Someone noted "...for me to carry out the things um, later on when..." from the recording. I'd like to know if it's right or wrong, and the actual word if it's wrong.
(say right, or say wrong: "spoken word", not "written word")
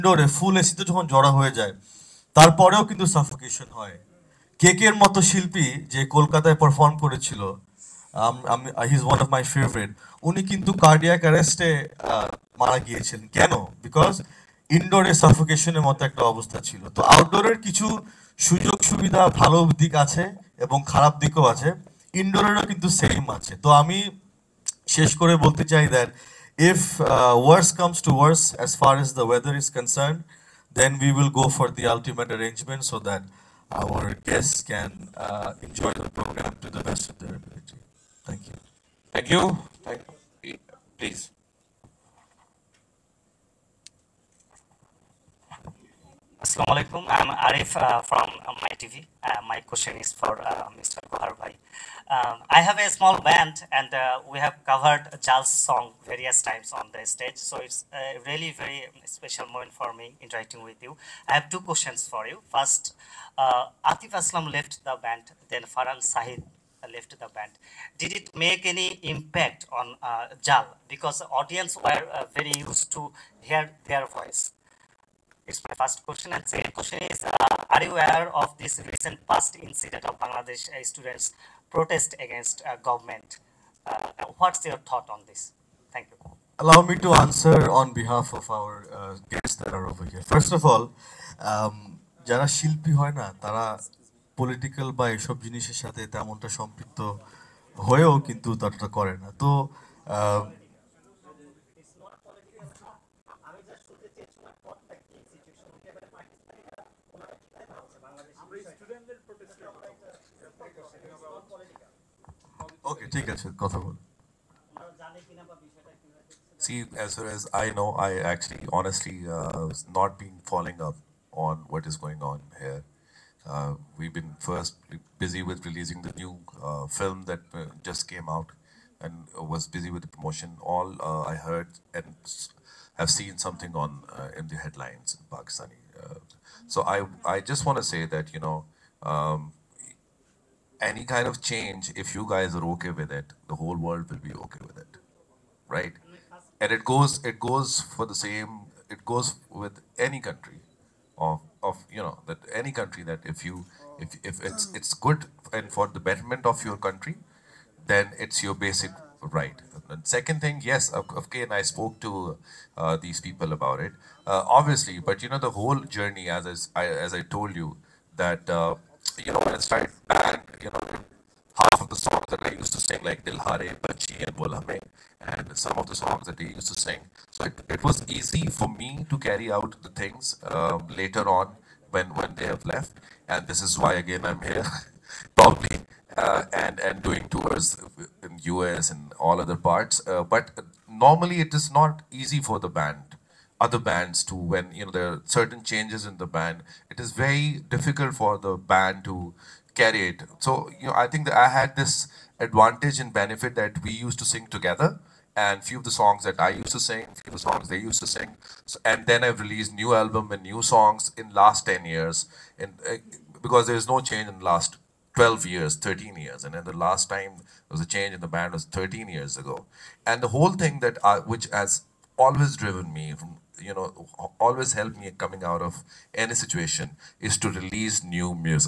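right.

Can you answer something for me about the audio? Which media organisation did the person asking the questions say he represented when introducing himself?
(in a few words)
My TV.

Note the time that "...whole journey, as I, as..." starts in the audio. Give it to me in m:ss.
2:45.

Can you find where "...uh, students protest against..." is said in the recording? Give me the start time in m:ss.
1:20.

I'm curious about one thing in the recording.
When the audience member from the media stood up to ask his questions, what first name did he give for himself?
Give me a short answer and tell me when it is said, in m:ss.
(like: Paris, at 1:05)
Arif, at 0:47.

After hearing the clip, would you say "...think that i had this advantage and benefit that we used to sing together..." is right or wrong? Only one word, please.
right.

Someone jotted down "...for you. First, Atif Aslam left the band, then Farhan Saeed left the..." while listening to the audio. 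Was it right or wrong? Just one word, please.
right.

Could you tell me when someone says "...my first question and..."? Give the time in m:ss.
1:15.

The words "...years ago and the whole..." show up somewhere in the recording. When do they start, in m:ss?
3:39.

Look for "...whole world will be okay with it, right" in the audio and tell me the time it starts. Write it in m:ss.
2:23.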